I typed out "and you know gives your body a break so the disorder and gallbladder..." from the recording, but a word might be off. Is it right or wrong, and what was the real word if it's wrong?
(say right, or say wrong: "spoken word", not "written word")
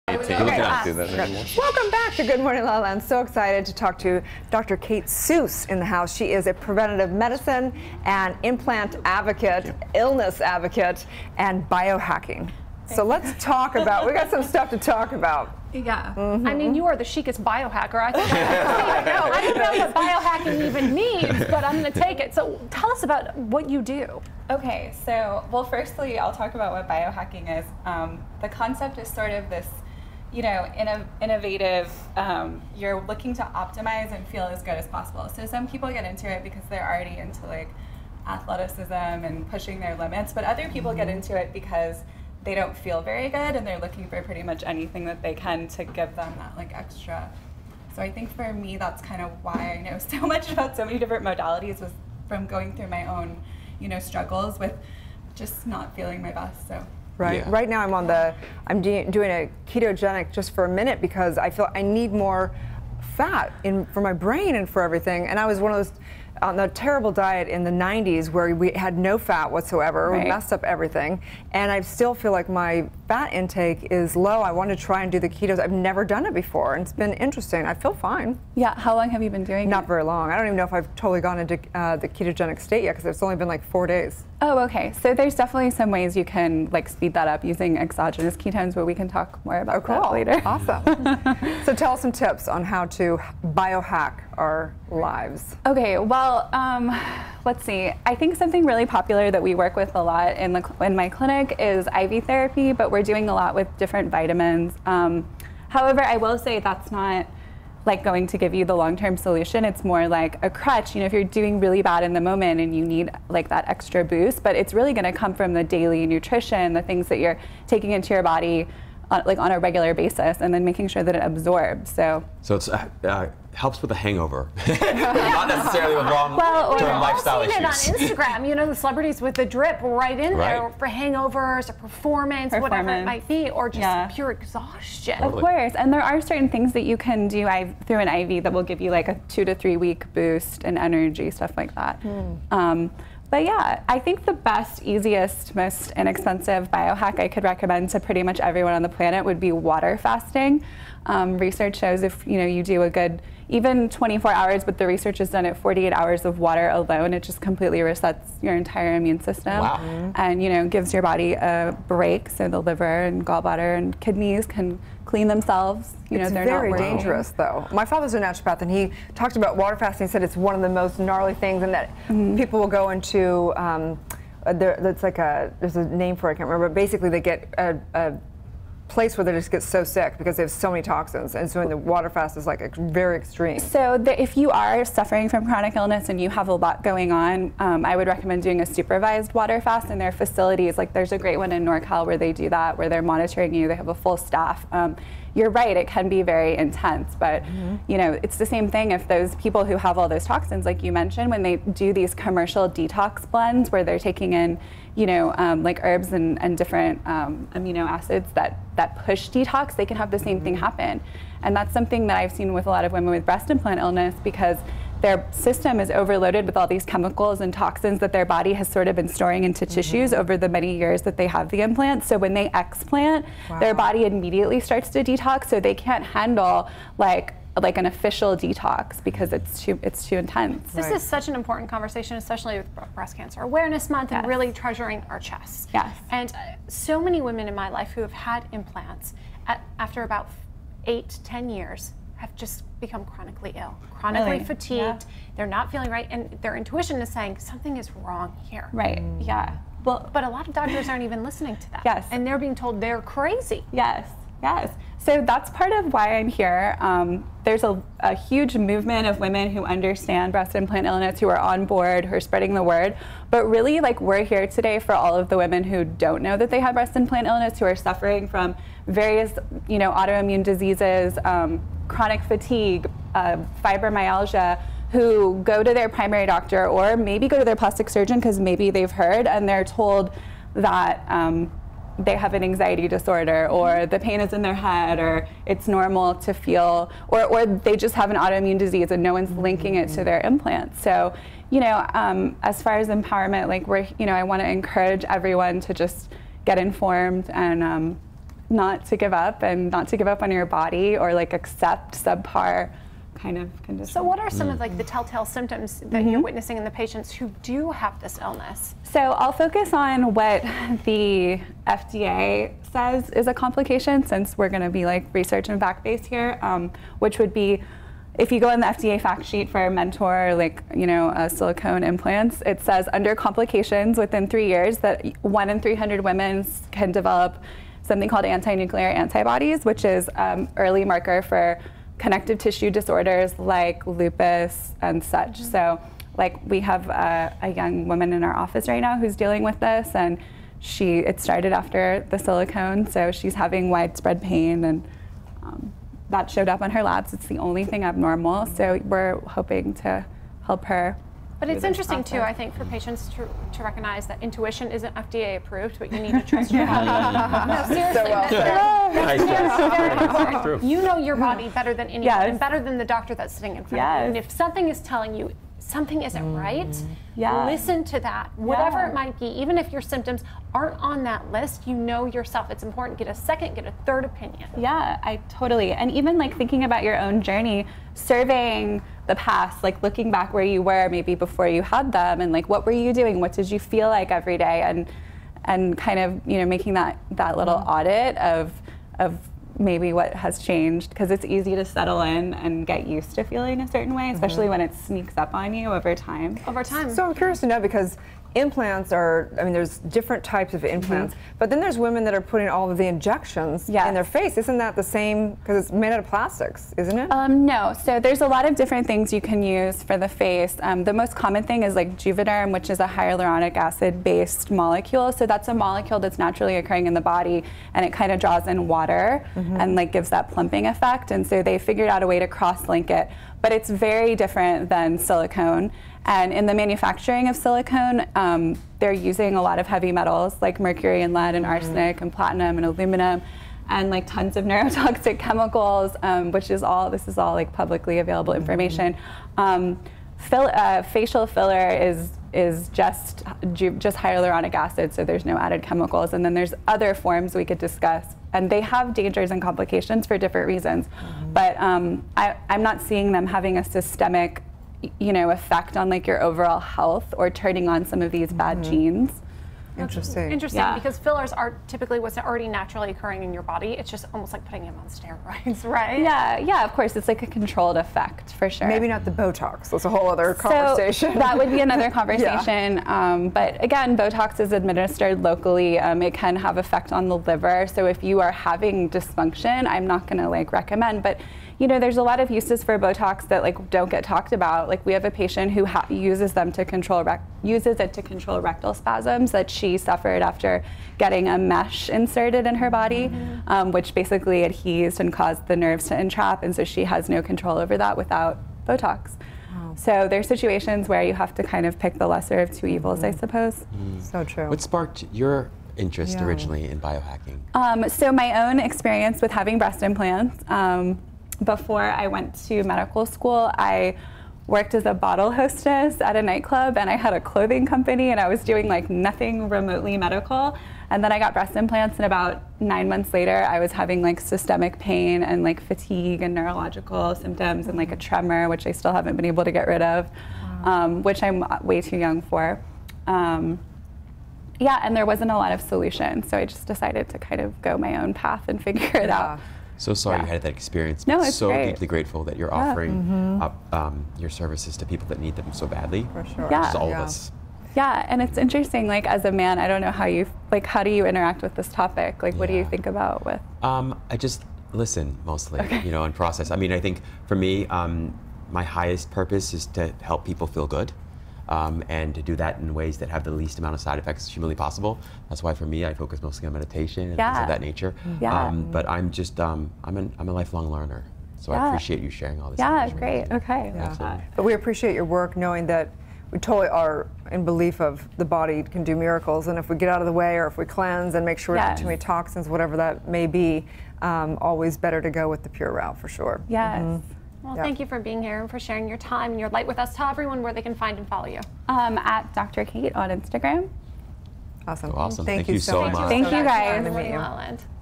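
wrong: "liver", not "disorder".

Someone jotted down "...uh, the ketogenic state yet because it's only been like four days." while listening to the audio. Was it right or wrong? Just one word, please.
right.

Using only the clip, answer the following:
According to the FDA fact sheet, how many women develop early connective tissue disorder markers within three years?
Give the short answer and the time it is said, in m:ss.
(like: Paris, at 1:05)
1 in 300, at 5:25.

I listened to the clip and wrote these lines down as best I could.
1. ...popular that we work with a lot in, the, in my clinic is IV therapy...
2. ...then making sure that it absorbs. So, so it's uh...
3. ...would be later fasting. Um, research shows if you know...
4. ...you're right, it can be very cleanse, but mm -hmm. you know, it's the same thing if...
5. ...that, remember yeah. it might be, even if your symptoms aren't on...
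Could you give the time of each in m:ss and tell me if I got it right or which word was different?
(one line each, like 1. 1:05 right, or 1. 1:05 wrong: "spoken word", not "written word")
1. 1:38 right
2. 2:00 right
3. 2:29 wrong: "water", not "later"
4. 3:15 wrong: "intense", not "cleanse"
5. 6:08 wrong: "whatever", not "remember".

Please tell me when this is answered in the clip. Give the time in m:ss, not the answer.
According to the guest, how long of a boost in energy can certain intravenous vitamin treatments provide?
2:19.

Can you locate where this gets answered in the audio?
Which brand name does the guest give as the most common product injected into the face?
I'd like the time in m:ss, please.
6:52.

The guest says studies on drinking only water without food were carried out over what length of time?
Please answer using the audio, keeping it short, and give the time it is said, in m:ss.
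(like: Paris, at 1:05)
48 hours, at 2:35.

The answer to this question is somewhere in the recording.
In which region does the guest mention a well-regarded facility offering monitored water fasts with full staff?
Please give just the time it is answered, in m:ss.
3:11.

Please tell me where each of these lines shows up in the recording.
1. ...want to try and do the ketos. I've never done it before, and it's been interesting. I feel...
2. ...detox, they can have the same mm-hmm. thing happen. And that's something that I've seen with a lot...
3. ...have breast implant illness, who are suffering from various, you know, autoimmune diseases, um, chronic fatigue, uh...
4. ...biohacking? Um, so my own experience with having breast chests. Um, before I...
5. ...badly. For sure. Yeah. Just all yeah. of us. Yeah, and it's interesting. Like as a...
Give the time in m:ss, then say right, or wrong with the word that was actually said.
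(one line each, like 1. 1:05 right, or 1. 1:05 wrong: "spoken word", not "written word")
1. 1:14 right
2. 3:29 right
3. 4:26 right
4. 8:26 wrong: "implants", not "chests"
5. 9:05 right.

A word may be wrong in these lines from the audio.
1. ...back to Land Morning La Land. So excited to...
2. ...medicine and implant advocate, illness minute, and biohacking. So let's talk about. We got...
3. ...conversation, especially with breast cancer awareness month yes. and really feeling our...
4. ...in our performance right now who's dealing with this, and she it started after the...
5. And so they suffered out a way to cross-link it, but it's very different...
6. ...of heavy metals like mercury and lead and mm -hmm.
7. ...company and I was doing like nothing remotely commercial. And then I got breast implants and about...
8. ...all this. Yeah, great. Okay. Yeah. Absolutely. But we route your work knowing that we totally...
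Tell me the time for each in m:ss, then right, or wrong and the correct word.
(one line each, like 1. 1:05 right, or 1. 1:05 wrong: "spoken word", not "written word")
1. 0:01 wrong: "Good", not "Land"
2. 0:07 wrong: "advocate", not "minute"
3. 3:51 wrong: "treasuring", not "feeling"
4. 5:38 wrong: "office", not "performance"
5. 7:01 wrong: "figured", not "suffered"
6. 7:09 right
7. 8:37 wrong: "medical", not "commercial"
8. 9:32 wrong: "appreciate", not "route".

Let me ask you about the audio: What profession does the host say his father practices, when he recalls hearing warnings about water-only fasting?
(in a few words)
Naturopath.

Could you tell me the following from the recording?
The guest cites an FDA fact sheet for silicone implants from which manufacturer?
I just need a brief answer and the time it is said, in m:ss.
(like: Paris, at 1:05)
Mentor, at 5:19.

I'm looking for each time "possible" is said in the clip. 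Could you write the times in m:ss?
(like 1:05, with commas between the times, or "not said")
0:34, 9:24.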